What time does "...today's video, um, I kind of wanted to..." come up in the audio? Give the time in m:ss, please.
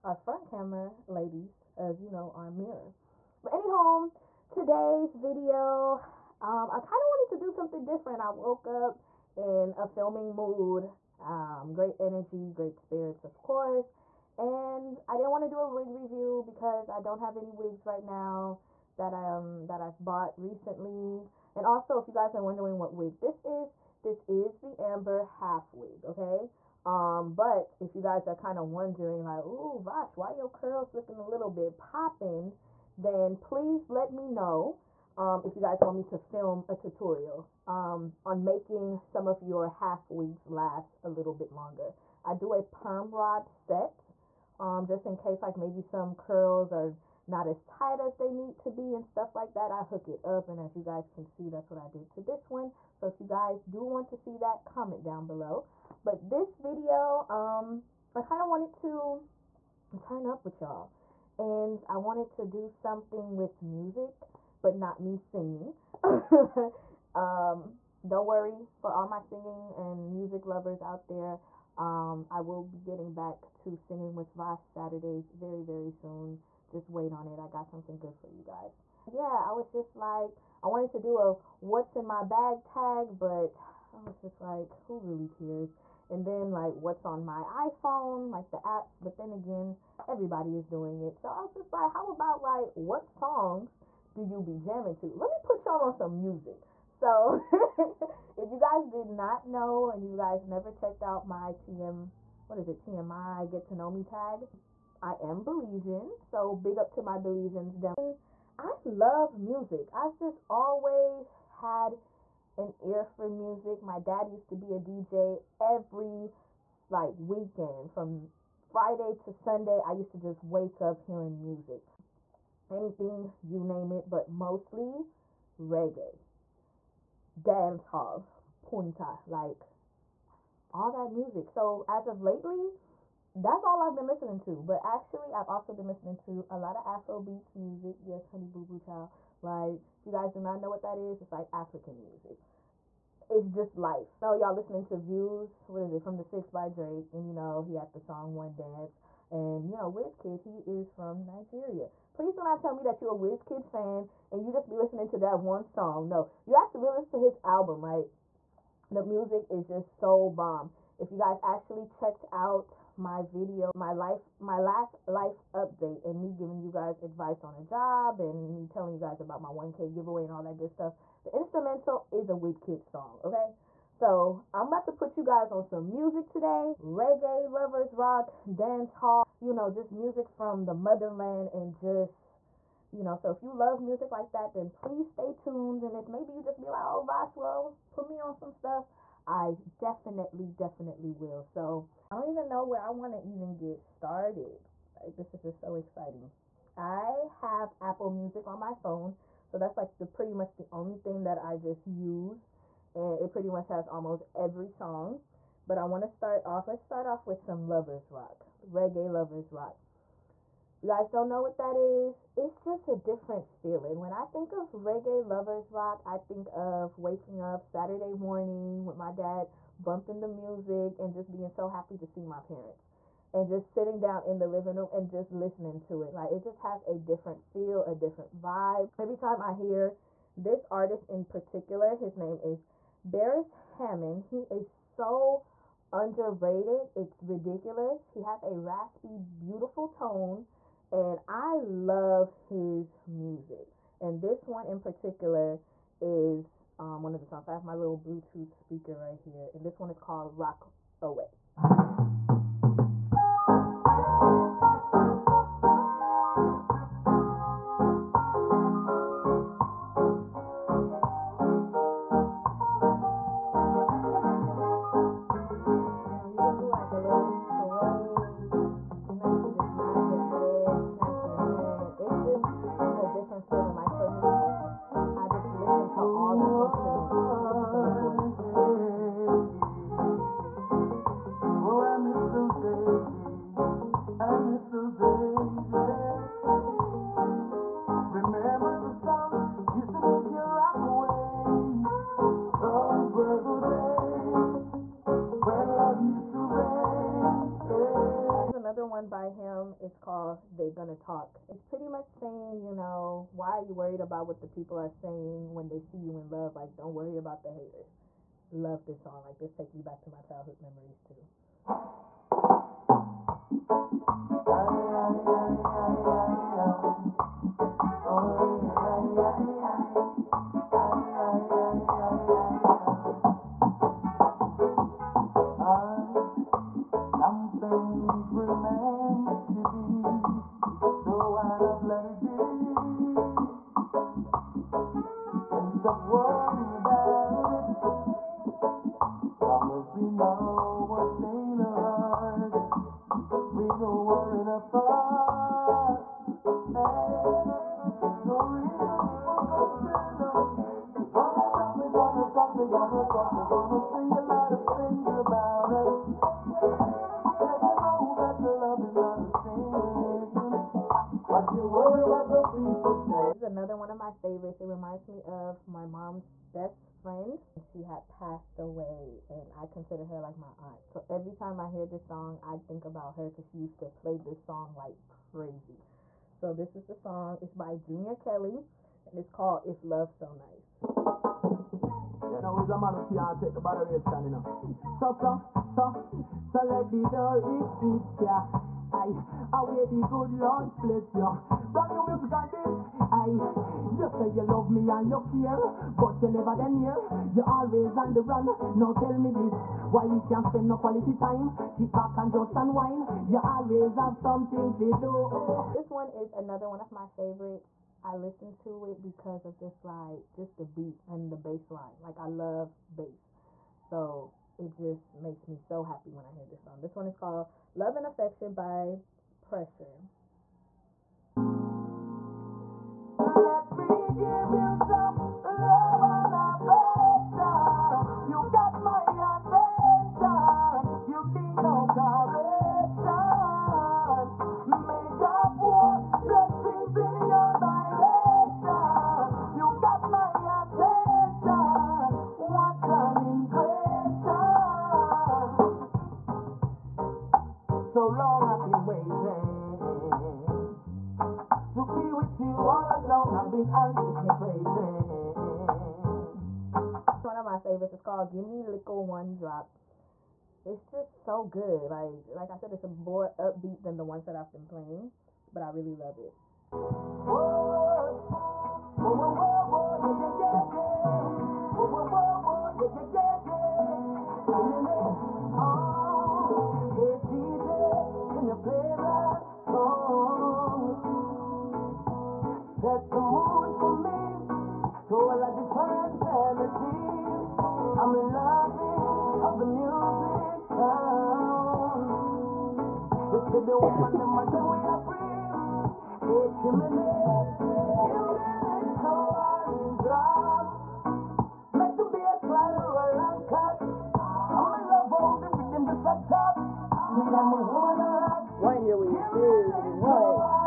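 0:04.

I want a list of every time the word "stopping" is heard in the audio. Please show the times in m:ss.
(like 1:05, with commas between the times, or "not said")
not said.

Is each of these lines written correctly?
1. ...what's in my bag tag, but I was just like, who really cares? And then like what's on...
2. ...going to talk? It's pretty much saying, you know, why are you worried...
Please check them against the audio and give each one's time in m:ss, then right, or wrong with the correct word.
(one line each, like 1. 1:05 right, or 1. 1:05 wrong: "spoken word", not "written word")
1. 1:21 right
2. 5:00 right.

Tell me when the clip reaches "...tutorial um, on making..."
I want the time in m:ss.
0:36.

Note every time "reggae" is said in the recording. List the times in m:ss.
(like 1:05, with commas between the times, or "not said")
2:05, 2:56, 3:28, 3:34.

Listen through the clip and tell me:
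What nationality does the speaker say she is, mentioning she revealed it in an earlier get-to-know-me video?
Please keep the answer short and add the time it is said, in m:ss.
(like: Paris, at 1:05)
Belizean, at 1:45.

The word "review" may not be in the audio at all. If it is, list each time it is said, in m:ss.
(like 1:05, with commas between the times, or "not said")
0:15.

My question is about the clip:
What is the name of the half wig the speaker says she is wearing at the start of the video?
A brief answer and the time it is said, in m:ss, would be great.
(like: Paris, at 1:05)
Amber, at 0:24.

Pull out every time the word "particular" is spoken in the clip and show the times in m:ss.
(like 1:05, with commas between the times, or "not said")
3:51, 4:04.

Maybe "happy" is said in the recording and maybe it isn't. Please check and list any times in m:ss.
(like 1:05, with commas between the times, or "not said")
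3:41, 6:55.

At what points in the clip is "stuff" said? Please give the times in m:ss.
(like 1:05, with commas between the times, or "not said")
0:49, 2:50, 3:08.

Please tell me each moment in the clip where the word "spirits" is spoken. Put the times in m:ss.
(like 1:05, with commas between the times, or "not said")
0:12.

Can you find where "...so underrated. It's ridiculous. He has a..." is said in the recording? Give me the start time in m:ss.
3:54.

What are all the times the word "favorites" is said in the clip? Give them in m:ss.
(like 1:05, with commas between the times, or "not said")
6:04, 6:47, 7:37.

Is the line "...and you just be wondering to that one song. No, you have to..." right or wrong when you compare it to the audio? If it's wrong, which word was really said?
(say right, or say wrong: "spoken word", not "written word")
wrong: "listening", not "wondering".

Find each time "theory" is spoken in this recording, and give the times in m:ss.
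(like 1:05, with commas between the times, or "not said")
not said.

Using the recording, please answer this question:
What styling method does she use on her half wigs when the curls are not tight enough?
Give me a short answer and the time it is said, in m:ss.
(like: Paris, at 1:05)
Perm rod set, at 0:42.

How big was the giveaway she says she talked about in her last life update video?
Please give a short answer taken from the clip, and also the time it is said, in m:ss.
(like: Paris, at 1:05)
1k, at 2:49.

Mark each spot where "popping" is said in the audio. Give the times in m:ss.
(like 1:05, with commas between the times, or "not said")
0:31.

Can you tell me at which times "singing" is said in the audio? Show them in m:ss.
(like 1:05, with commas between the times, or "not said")
1:05, 1:09, 1:13.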